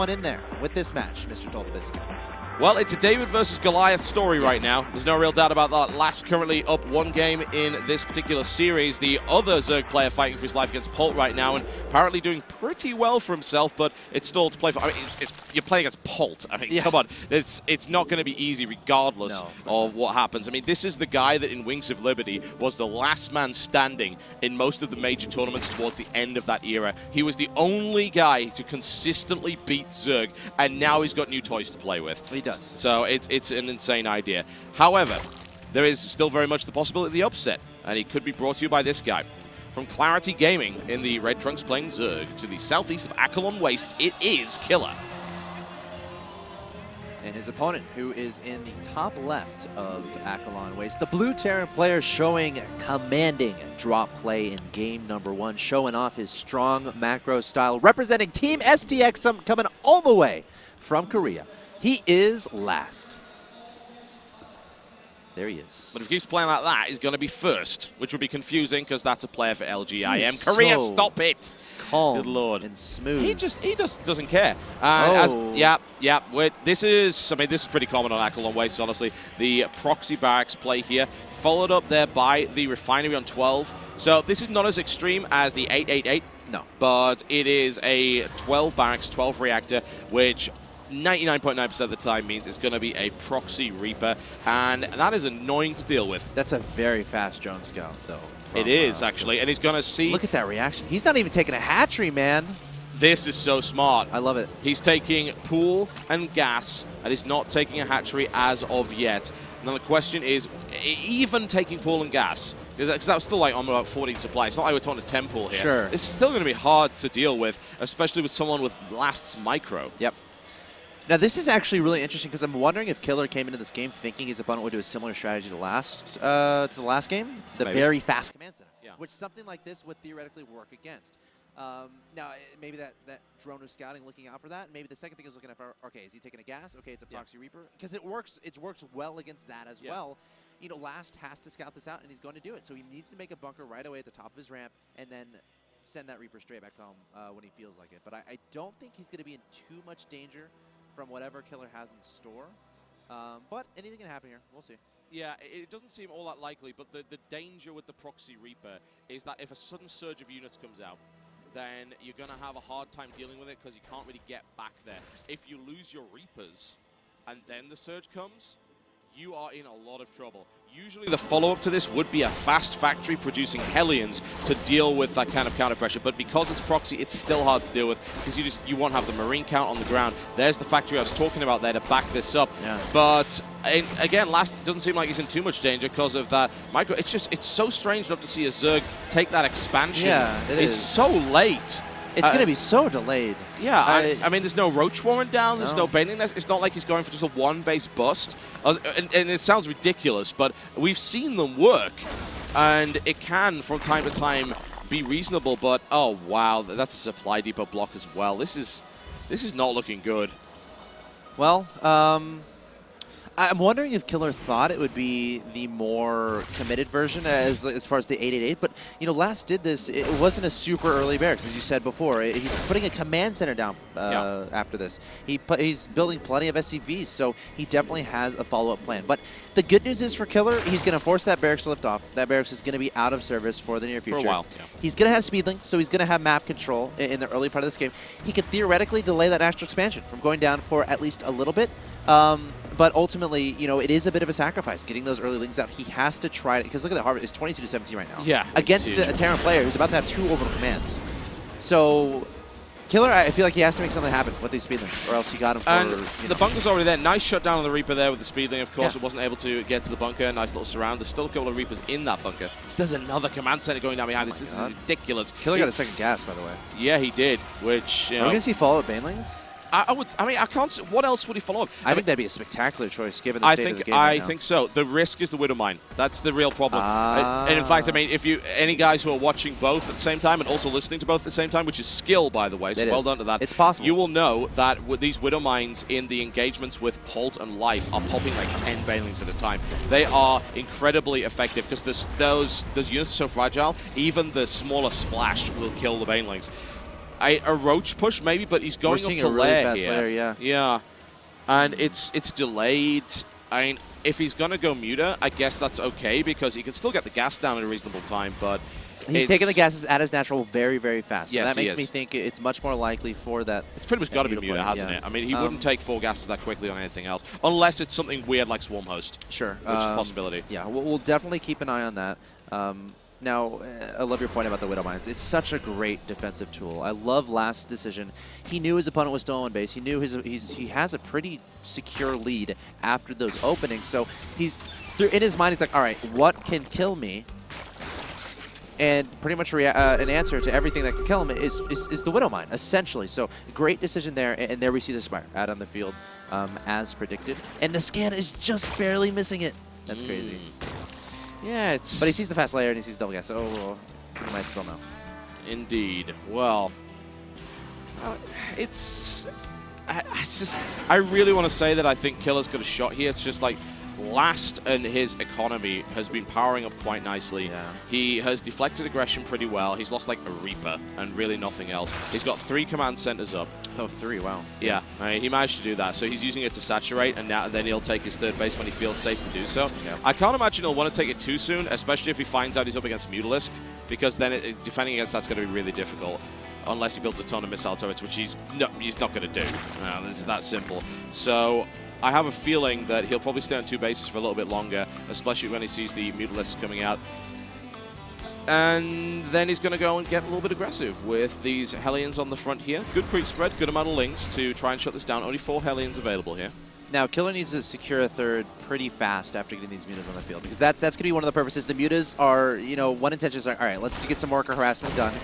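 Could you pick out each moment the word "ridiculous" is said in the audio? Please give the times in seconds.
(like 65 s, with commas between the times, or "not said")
199 s, 264 s.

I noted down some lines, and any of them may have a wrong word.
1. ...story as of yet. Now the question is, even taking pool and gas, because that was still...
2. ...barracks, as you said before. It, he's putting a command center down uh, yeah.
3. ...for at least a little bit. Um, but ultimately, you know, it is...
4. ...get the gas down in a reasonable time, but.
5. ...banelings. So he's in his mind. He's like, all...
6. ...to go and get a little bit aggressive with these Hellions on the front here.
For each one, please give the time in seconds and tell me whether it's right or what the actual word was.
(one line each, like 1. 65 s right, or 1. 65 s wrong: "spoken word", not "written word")
1. 107 s wrong: "hatchery", not "story"
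2. 221 s right
3. 240 s right
4. 306 s right
5. 333 s wrong: "openings", not "banelings"
6. 399 s right.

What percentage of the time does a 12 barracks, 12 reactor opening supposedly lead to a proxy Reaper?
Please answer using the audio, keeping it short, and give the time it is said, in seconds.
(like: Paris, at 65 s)
99.9%, at 90 s.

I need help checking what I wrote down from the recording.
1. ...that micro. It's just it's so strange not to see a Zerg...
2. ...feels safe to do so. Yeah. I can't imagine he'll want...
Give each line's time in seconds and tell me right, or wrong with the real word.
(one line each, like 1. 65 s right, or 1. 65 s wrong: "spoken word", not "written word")
1. 186 s right
2. 378 s right.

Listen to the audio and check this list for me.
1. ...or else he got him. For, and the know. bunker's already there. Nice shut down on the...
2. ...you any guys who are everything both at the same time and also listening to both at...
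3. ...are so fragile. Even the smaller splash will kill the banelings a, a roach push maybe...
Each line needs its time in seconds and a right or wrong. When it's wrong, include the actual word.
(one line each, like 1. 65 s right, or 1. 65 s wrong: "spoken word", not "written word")
1. 255 s right
2. 278 s wrong: "watching", not "everything"
3. 293 s right.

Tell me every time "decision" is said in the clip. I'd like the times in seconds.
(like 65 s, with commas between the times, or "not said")
327 s, 343 s.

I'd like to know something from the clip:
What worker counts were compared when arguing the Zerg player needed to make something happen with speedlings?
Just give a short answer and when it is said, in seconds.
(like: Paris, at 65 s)
22 to 17, at 247 s.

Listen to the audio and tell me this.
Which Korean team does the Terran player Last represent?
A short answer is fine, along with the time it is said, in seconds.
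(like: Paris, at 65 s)
Team STX, at 58 s.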